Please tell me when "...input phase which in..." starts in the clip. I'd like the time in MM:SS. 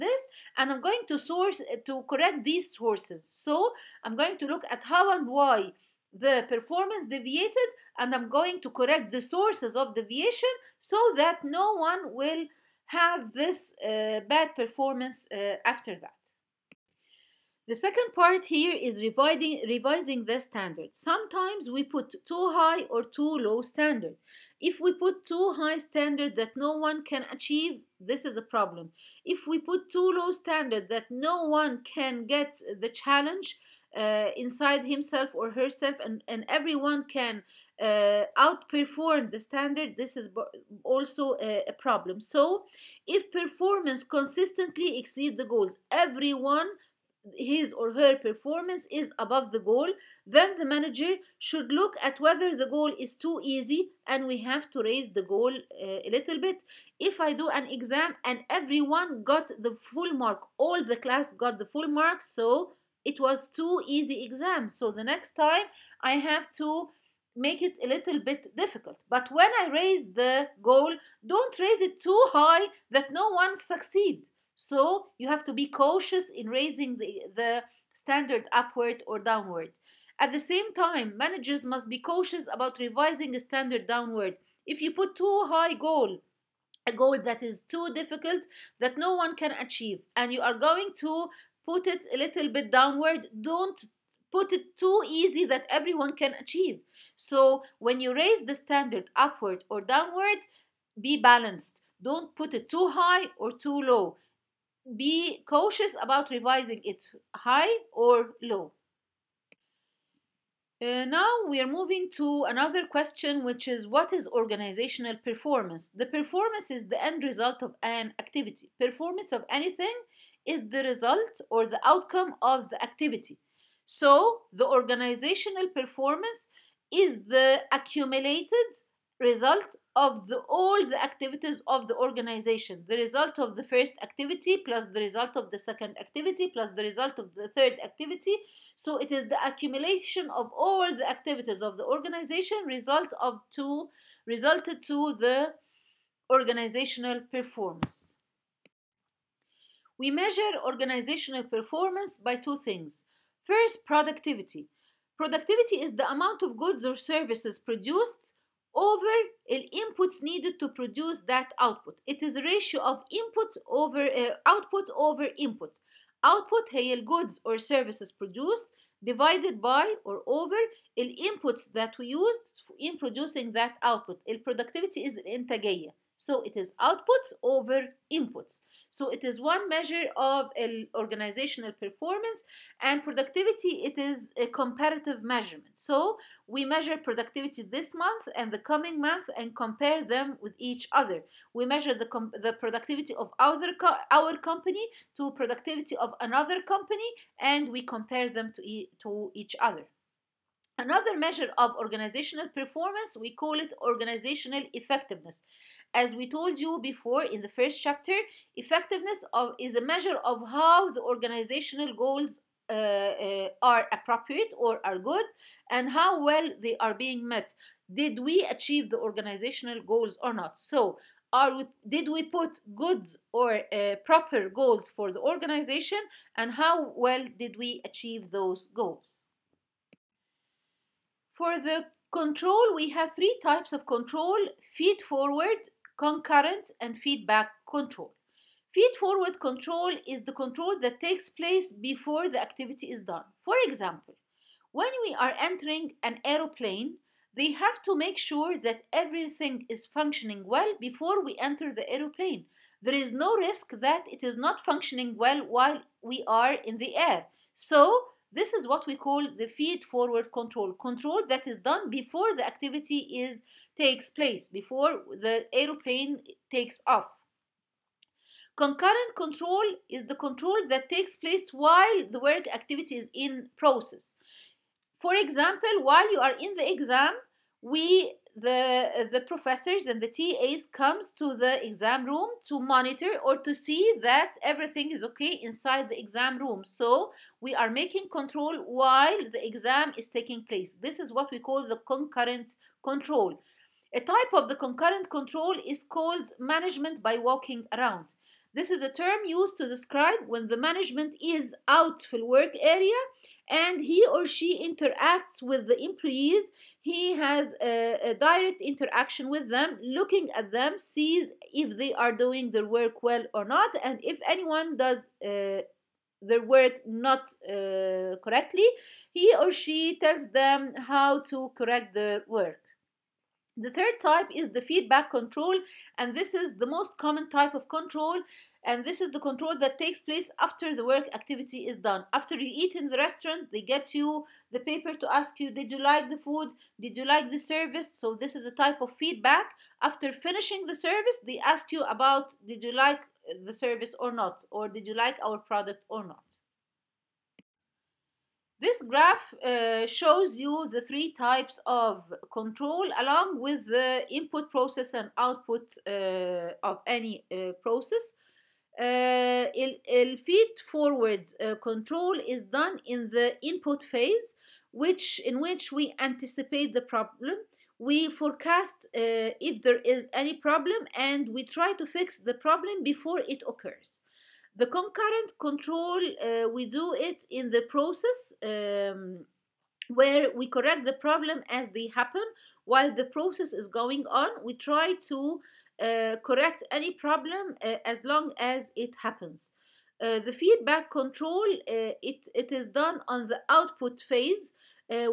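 06:03.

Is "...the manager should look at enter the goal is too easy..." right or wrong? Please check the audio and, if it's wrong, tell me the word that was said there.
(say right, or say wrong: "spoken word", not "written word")
wrong: "whether", not "enter".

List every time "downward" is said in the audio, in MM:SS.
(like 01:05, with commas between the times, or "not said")
01:19, 01:23, 01:32, 01:39.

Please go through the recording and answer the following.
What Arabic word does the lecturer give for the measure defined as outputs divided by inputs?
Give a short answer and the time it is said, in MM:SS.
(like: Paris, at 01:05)
الإنتاجية, at 02:55.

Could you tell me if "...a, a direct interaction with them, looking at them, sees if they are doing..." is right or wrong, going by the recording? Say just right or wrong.
right.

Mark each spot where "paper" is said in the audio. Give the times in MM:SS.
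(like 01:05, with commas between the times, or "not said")
05:34.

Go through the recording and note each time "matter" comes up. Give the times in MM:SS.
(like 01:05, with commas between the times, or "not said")
not said.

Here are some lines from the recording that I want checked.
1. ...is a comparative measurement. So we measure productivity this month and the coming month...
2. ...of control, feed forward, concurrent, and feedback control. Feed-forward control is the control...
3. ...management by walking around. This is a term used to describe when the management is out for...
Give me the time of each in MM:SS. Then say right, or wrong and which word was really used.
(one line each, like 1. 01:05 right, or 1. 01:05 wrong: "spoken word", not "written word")
1. 03:03 right
2. 03:53 right
3. 04:56 right.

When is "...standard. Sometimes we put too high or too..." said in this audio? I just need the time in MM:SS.
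00:20.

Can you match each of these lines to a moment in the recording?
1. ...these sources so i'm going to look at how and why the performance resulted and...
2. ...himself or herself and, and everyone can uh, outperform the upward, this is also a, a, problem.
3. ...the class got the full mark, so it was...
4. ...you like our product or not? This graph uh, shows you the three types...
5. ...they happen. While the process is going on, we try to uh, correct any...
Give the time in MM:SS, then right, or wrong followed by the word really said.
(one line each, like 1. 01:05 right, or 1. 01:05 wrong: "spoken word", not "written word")
1. 00:02 wrong: "deviated", not "resulted"
2. 00:34 wrong: "standard", not "upward"
3. 01:00 right
4. 05:44 right
5. 06:21 right.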